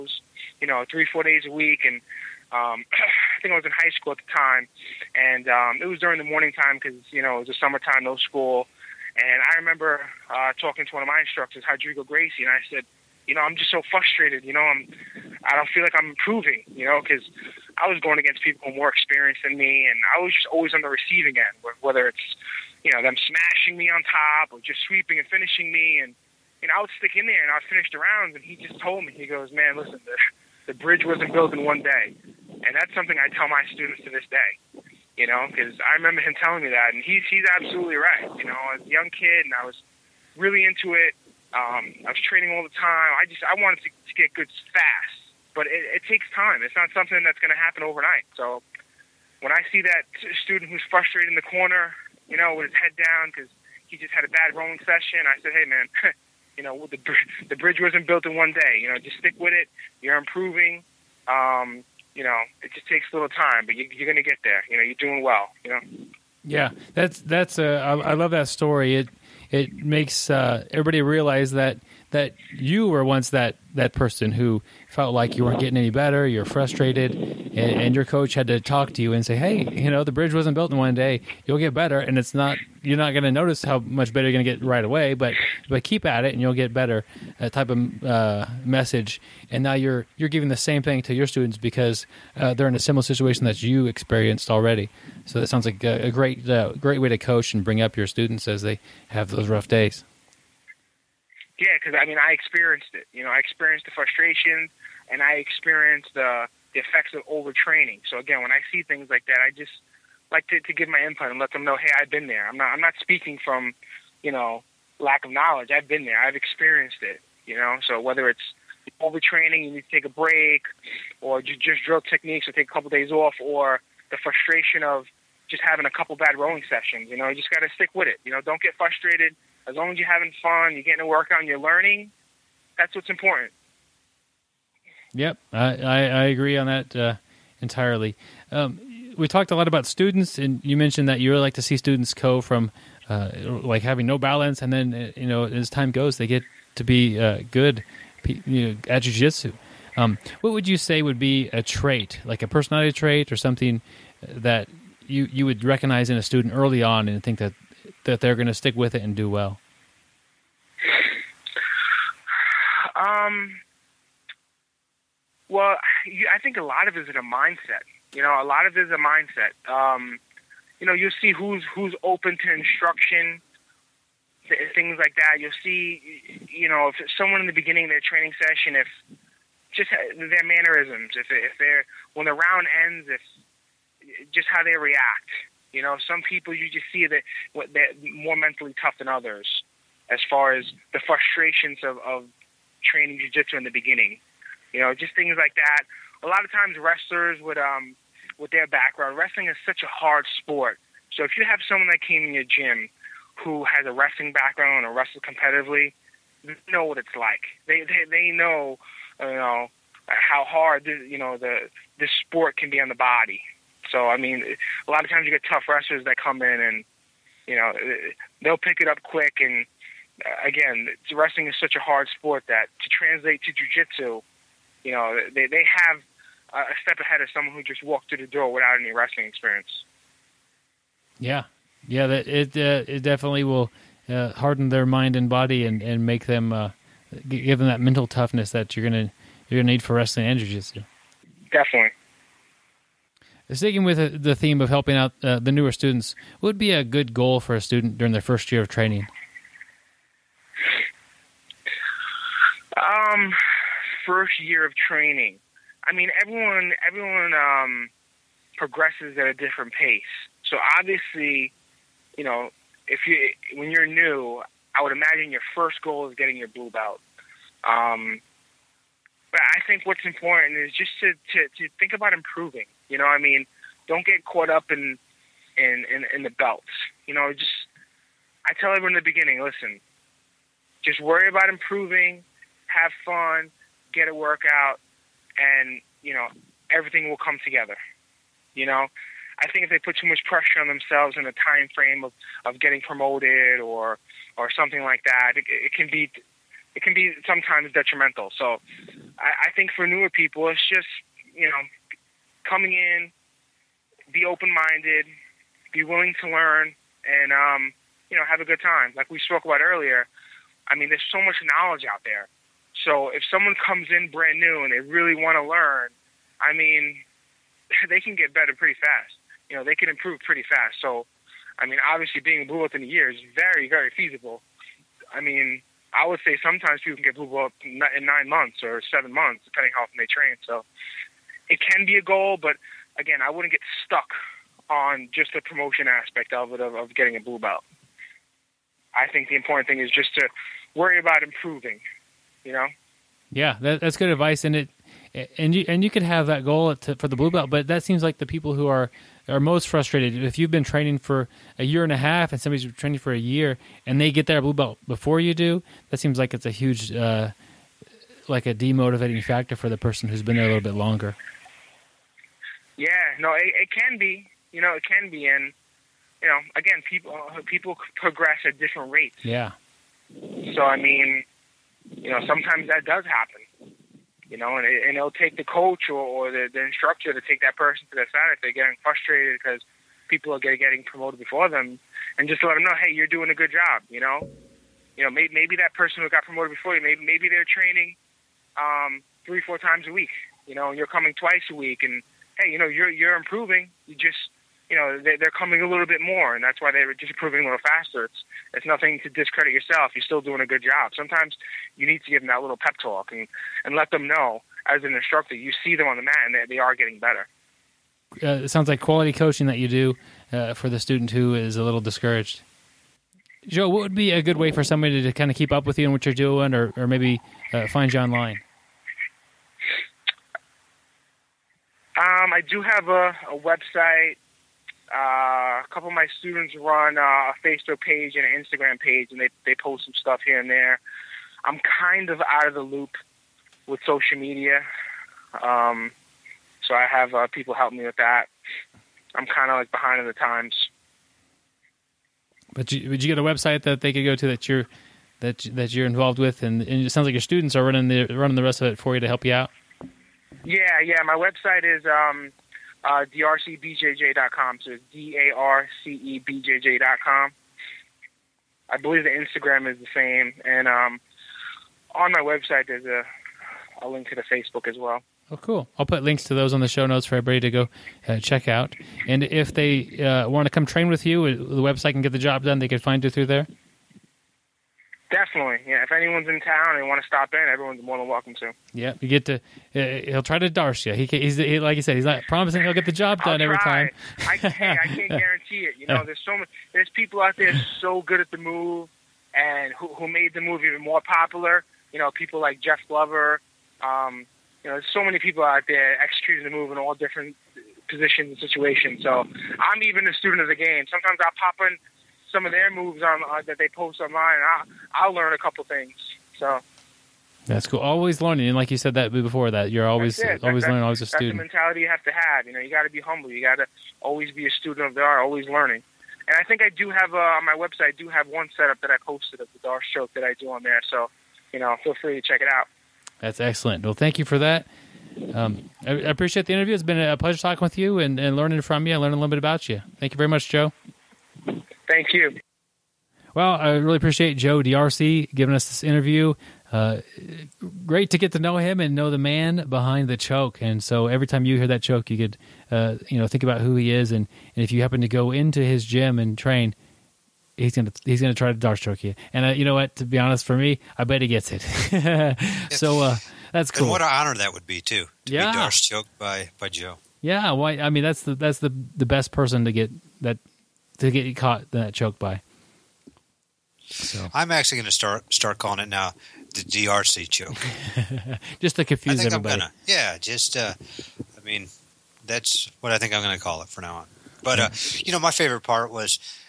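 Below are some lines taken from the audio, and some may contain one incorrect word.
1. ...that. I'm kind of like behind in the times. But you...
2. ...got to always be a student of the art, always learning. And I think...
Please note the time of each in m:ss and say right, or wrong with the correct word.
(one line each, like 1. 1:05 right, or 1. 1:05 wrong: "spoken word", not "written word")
1. 7:17 right
2. 8:33 right.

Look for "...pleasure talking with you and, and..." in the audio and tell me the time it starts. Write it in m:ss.
8:47.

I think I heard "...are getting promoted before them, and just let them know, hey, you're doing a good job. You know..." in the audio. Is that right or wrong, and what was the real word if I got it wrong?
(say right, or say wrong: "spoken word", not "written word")
right.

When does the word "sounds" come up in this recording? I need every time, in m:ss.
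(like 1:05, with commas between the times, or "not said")
1:35, 6:48, 7:26.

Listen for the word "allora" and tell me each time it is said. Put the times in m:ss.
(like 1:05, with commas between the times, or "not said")
not said.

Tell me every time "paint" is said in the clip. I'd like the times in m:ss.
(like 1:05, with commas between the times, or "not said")
not said.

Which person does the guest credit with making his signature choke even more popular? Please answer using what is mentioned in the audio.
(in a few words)
Jeff Glover.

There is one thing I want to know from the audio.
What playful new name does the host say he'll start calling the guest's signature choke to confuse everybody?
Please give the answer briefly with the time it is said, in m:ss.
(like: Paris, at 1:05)
DRC choke, at 9:26.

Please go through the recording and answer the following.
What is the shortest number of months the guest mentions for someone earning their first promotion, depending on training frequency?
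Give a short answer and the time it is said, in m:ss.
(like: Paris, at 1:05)
7, at 5:28.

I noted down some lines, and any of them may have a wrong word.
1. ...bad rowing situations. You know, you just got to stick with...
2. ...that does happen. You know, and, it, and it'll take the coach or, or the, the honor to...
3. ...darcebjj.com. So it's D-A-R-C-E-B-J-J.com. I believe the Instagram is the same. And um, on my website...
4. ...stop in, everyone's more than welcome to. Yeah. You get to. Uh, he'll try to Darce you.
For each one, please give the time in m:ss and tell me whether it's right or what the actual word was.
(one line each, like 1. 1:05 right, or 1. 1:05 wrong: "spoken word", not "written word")
1. 2:06 wrong: "sessions", not "situations"
2. 6:12 wrong: "instructor", not "honor"
3. 7:33 right
4. 7:57 right.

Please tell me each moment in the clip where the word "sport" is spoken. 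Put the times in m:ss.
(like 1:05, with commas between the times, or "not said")
3:20, 3:32, 3:42.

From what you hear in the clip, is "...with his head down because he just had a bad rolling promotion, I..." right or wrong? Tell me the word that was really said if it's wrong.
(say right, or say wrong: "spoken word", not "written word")
wrong: "session", not "promotion".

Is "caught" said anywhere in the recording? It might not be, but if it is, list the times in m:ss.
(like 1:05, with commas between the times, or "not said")
4:34, 9:21.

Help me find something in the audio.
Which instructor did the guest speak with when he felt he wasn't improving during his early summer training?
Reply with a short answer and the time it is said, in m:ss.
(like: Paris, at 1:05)
Rodrigo Gracie, at 0:11.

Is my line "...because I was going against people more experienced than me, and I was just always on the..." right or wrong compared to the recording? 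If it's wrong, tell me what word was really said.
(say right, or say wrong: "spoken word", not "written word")
right.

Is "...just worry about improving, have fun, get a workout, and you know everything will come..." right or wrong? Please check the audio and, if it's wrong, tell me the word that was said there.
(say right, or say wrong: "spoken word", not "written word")
right.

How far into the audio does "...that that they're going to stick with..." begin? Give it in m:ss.
2:37.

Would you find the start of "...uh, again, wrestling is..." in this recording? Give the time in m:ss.
3:40.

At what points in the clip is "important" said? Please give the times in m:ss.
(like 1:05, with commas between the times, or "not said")
2:13, 4:30, 5:39.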